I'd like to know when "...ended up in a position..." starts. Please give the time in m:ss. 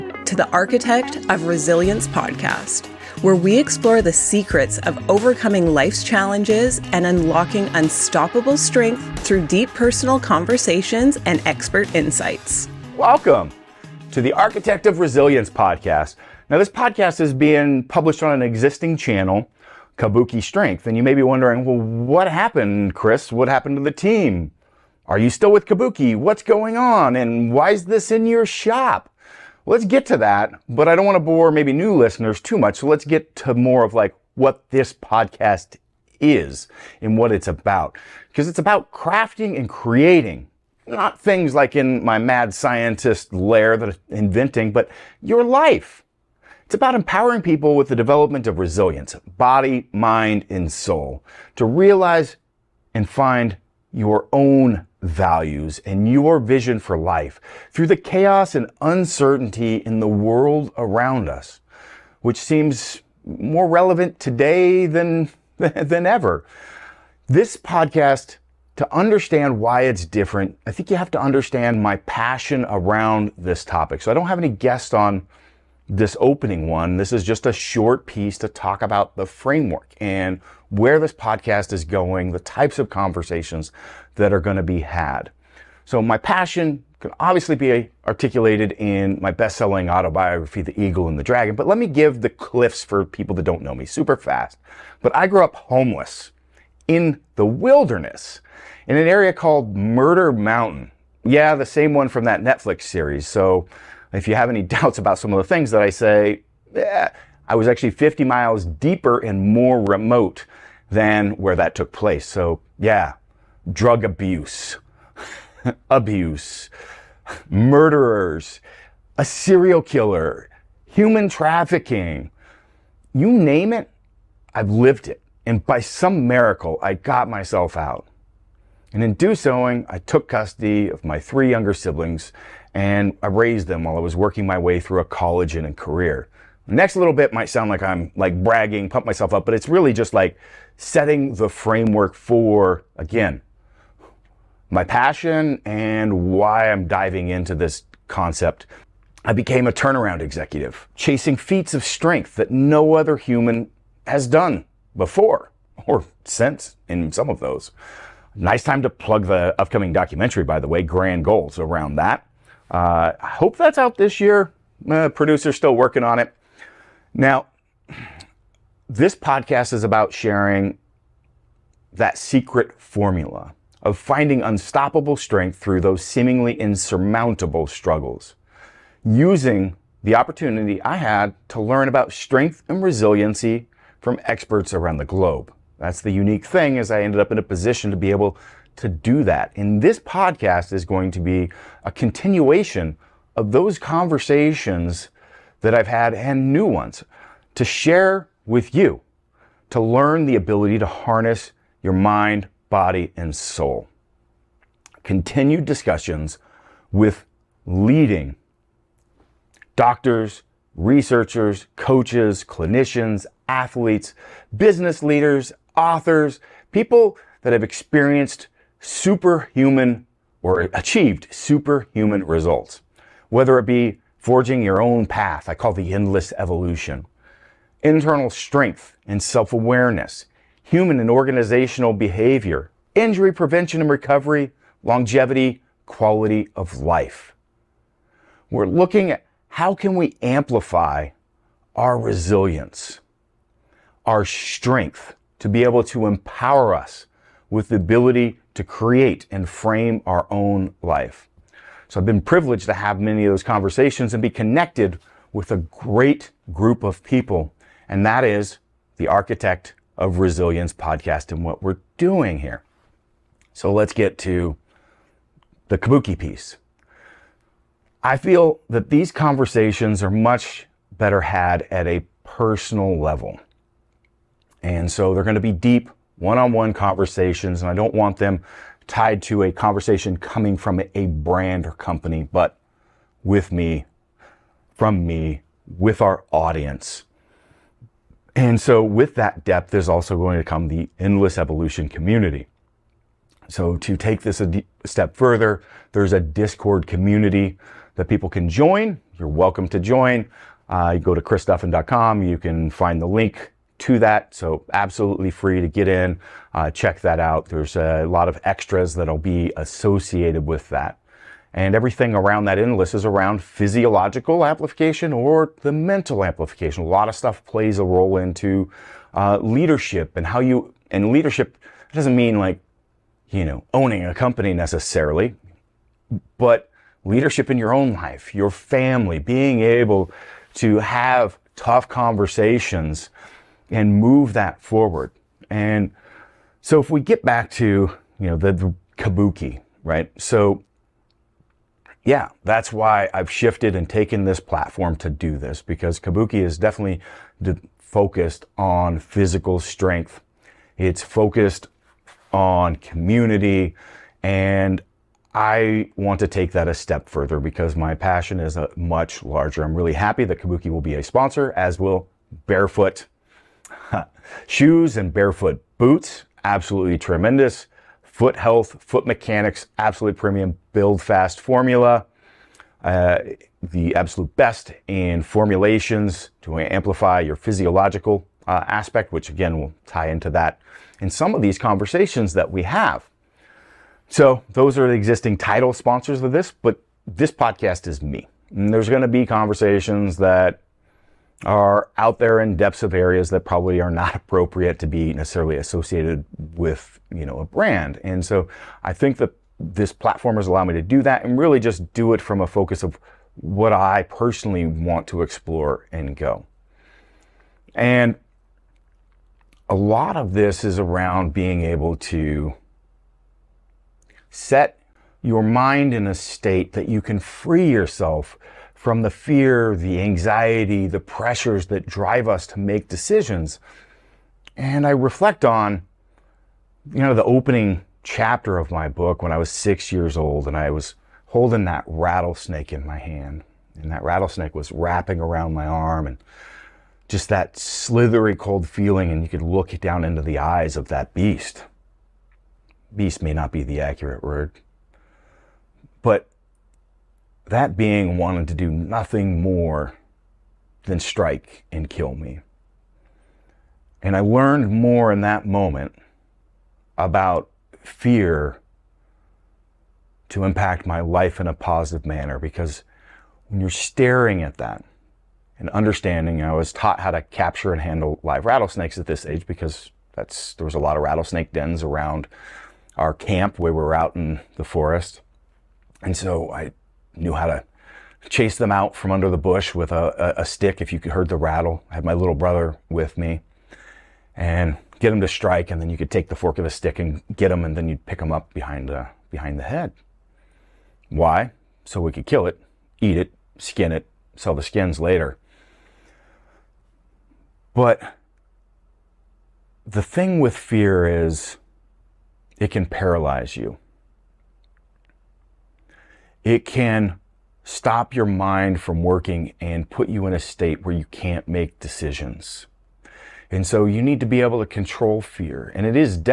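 3:07.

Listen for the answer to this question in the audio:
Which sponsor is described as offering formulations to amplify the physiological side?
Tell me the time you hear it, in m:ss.
6:10.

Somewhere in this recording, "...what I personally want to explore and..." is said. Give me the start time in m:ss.
6:43.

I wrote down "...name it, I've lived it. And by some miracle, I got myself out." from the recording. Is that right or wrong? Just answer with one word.
right.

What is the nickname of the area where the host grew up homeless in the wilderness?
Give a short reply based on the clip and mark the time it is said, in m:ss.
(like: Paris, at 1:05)
Murder Mountain, at 1:39.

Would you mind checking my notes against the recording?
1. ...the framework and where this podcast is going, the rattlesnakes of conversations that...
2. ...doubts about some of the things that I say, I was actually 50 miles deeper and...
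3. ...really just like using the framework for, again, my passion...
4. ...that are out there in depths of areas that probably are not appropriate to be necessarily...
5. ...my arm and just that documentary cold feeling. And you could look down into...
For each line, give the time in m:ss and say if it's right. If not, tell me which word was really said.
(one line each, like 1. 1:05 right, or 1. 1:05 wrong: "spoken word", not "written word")
1. 1:19 wrong: "types", not "rattlesnakes"
2. 1:44 right
3. 2:19 wrong: "setting", not "using"
4. 6:30 right
5. 7:15 wrong: "slithery", not "documentary".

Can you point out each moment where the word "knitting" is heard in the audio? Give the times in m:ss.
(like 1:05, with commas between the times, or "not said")
not said.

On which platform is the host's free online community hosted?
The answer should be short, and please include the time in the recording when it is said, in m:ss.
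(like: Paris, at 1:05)
Discord, at 4:56.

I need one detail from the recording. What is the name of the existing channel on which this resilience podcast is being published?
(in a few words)
Kabuki Strength.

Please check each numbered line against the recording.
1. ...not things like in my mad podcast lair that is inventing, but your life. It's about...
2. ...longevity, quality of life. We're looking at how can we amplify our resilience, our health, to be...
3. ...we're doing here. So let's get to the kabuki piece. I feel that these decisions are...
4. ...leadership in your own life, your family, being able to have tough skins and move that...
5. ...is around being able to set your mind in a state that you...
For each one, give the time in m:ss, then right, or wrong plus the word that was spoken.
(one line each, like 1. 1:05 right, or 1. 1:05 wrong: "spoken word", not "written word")
1. 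0:40 wrong: "scientist", not "podcast"
2. 3:54 wrong: "strength", not "health"
3. 4:21 wrong: "conversations", not "decisions"
4. 5:27 wrong: "conversations", not "skins"
5. 6:50 right.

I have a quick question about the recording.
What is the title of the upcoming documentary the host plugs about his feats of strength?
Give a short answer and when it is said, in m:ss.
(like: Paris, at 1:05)
Grand Goals, at 2:40.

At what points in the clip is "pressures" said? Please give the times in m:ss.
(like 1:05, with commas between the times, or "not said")
7:00.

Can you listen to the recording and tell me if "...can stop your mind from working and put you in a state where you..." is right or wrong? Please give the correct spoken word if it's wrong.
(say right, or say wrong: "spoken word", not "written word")
right.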